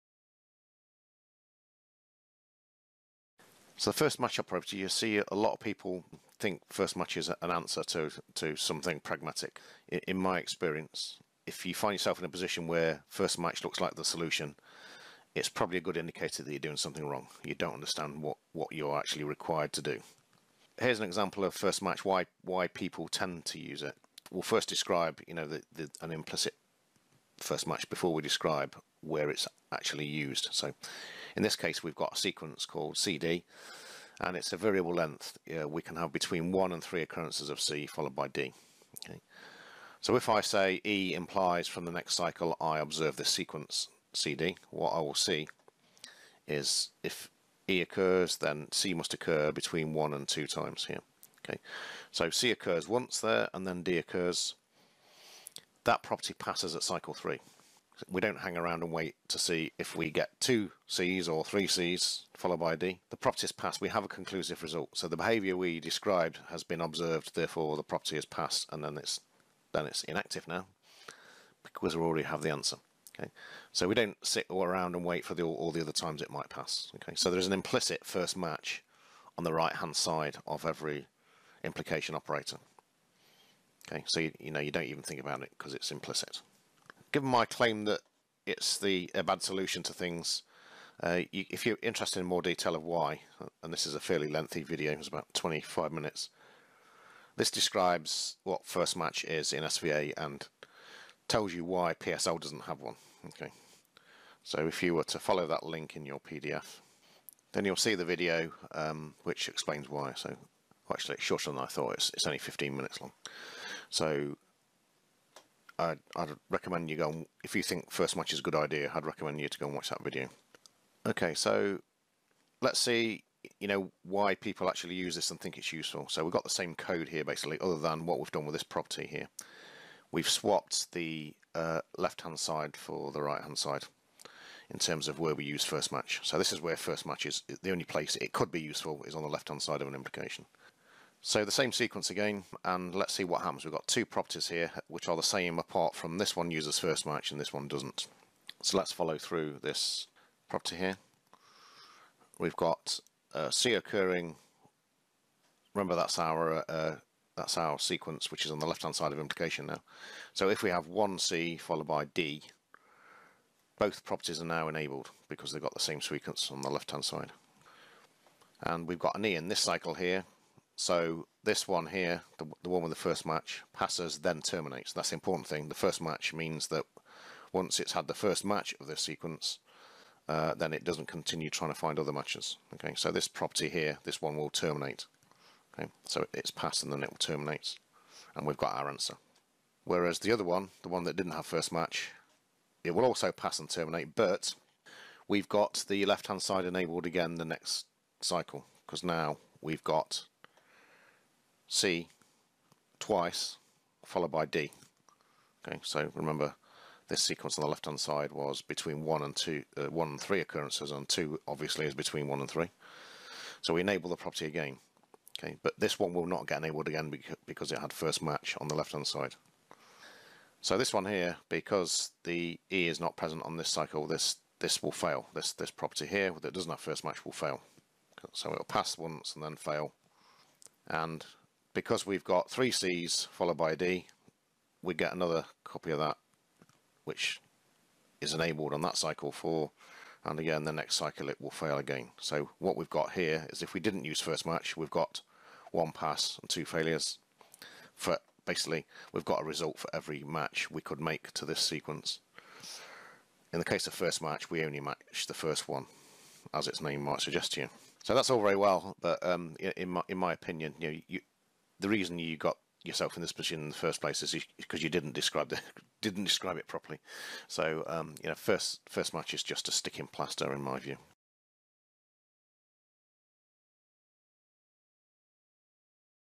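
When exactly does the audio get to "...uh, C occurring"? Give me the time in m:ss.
2:33.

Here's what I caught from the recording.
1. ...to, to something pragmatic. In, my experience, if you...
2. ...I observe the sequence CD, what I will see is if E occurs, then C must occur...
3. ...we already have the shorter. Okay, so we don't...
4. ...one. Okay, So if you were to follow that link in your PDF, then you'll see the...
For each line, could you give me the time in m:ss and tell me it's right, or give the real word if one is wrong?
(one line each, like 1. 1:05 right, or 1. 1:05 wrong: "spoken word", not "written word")
1. 0:07 right
2. 0:42 right
3. 1:11 wrong: "answer", not "shorter"
4. 1:42 right.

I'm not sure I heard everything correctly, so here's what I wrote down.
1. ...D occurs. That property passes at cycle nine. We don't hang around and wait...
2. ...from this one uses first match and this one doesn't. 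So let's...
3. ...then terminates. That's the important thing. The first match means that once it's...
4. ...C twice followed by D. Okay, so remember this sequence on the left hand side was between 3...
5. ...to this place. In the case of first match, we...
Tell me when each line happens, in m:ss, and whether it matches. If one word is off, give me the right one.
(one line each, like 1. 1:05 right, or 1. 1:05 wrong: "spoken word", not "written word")
1. 0:53 wrong: "three", not "nine"
2. 2:25 right
3. 2:54 right
4. 3:21 wrong: "1", not "3"
5. 4:11 wrong: "sequence", not "place".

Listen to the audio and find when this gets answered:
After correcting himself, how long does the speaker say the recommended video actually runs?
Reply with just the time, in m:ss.
1:52.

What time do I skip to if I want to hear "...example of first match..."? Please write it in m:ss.
0:21.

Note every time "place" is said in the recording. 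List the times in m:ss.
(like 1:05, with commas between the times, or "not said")
2:17, 4:24.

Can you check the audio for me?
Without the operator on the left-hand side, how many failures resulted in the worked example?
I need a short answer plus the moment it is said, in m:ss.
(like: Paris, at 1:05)
2, at 4:06.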